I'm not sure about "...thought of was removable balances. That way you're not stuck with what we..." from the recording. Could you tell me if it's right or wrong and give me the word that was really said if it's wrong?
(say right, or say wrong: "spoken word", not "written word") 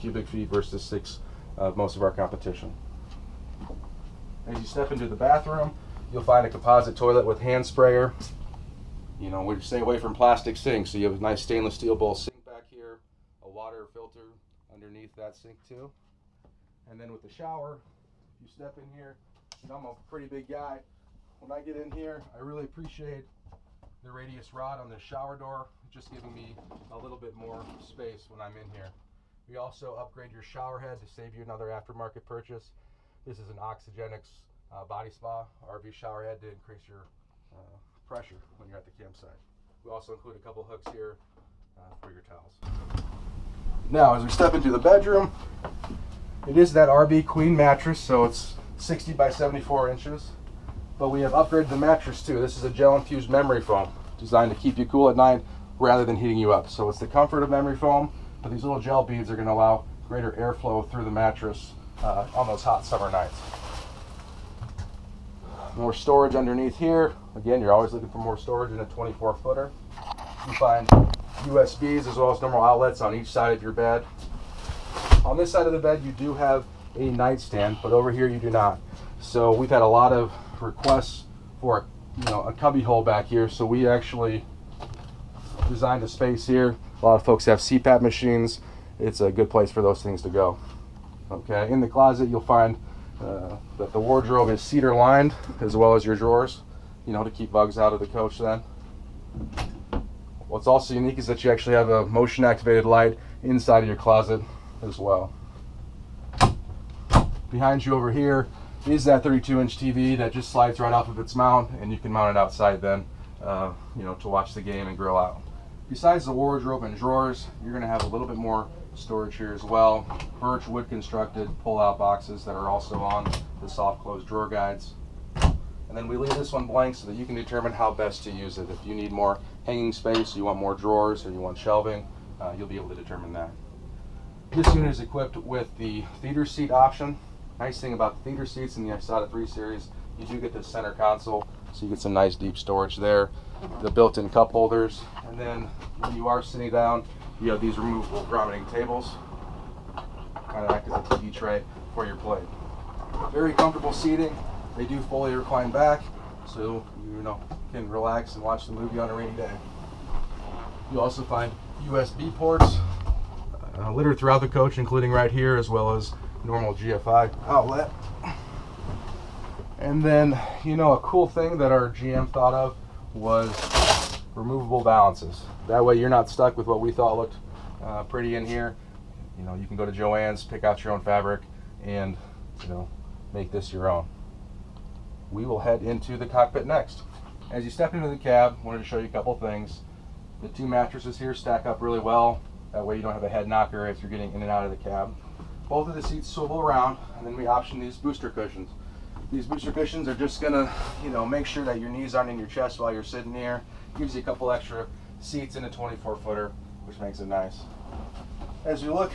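right.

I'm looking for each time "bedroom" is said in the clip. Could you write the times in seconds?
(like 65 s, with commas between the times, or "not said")
44 s.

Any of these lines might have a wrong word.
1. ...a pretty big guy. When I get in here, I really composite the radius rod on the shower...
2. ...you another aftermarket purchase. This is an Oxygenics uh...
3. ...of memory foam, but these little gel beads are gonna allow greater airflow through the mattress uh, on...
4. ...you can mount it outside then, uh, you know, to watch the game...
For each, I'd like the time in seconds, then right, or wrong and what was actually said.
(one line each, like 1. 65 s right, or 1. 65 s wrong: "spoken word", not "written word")
1. 19 s wrong: "appreciate", not "composite"
2. 31 s right
3. 57 s right
4. 111 s right.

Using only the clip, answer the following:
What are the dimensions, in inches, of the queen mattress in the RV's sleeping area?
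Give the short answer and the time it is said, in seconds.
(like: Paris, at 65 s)
60 by 74 inches, at 48 s.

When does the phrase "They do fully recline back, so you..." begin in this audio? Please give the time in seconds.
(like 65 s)
154 s.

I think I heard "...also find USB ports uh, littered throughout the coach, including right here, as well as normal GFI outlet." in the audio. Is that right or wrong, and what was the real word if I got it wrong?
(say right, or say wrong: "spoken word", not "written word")
right.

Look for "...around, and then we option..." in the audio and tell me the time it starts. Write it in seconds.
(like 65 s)
196 s.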